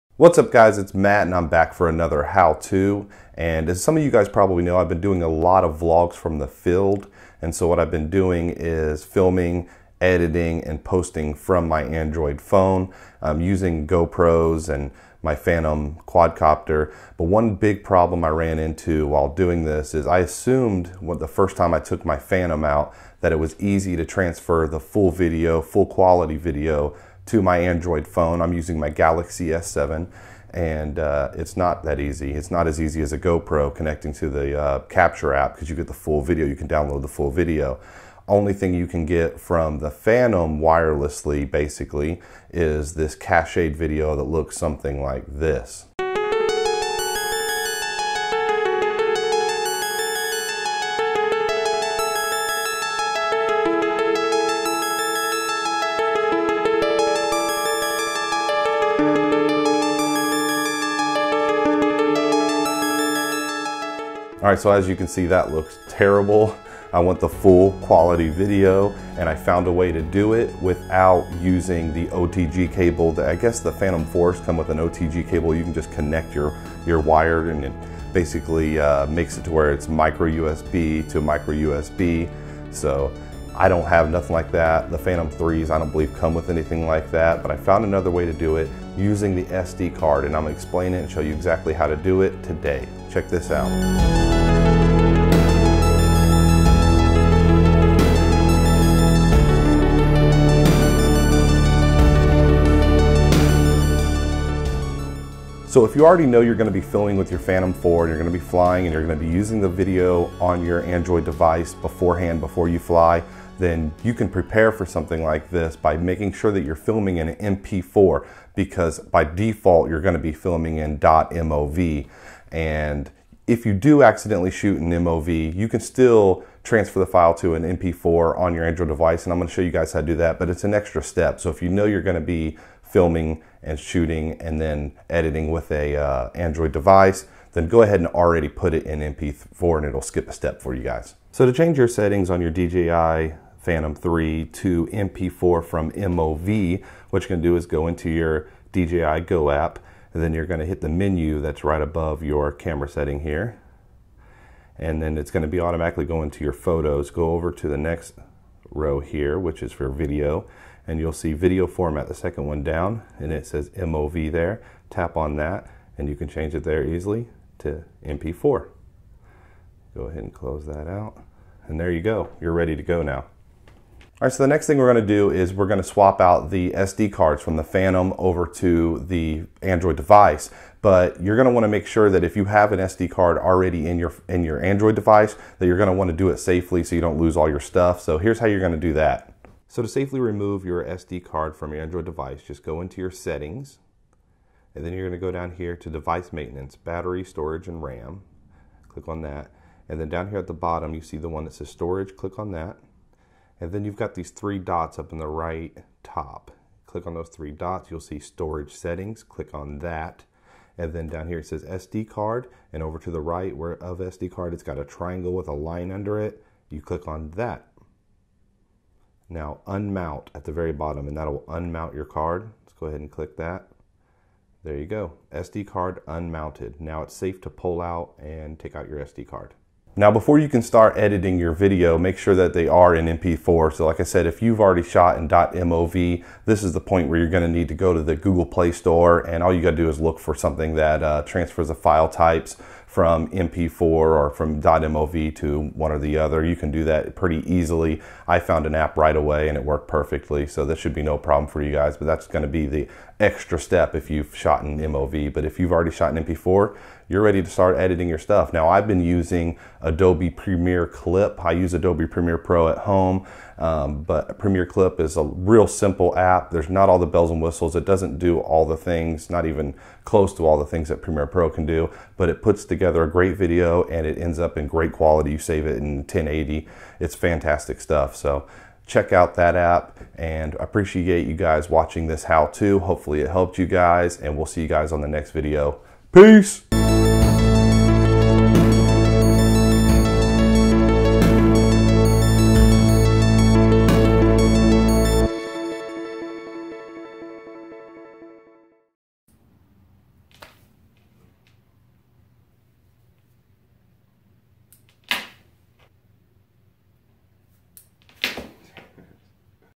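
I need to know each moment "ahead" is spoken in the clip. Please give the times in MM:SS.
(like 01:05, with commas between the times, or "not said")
02:17, 02:50, 03:42.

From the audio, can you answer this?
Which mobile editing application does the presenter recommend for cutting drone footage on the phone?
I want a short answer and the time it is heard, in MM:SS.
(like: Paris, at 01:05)
Adobe Premiere Clip, at 04:19.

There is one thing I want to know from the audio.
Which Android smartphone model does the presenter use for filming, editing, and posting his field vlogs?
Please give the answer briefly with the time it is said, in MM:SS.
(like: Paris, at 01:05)
Galaxy S7, at 00:28.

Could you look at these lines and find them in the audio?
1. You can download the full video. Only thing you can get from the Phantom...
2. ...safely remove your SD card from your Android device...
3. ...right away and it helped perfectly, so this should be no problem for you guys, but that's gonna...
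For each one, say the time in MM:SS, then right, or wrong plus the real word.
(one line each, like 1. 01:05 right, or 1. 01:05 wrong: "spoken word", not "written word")
1. 00:36 right
2. 03:09 right
3. 04:08 wrong: "worked", not "helped".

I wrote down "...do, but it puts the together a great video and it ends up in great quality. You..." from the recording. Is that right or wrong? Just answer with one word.
right.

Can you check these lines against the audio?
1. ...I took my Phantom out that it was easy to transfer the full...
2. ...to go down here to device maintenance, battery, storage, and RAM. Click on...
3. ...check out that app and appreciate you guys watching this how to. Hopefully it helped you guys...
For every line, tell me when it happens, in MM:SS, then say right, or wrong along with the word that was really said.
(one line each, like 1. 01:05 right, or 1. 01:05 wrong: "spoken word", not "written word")
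1. 00:21 right
2. 03:15 right
3. 04:38 right.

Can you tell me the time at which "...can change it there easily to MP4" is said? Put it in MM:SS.
02:46.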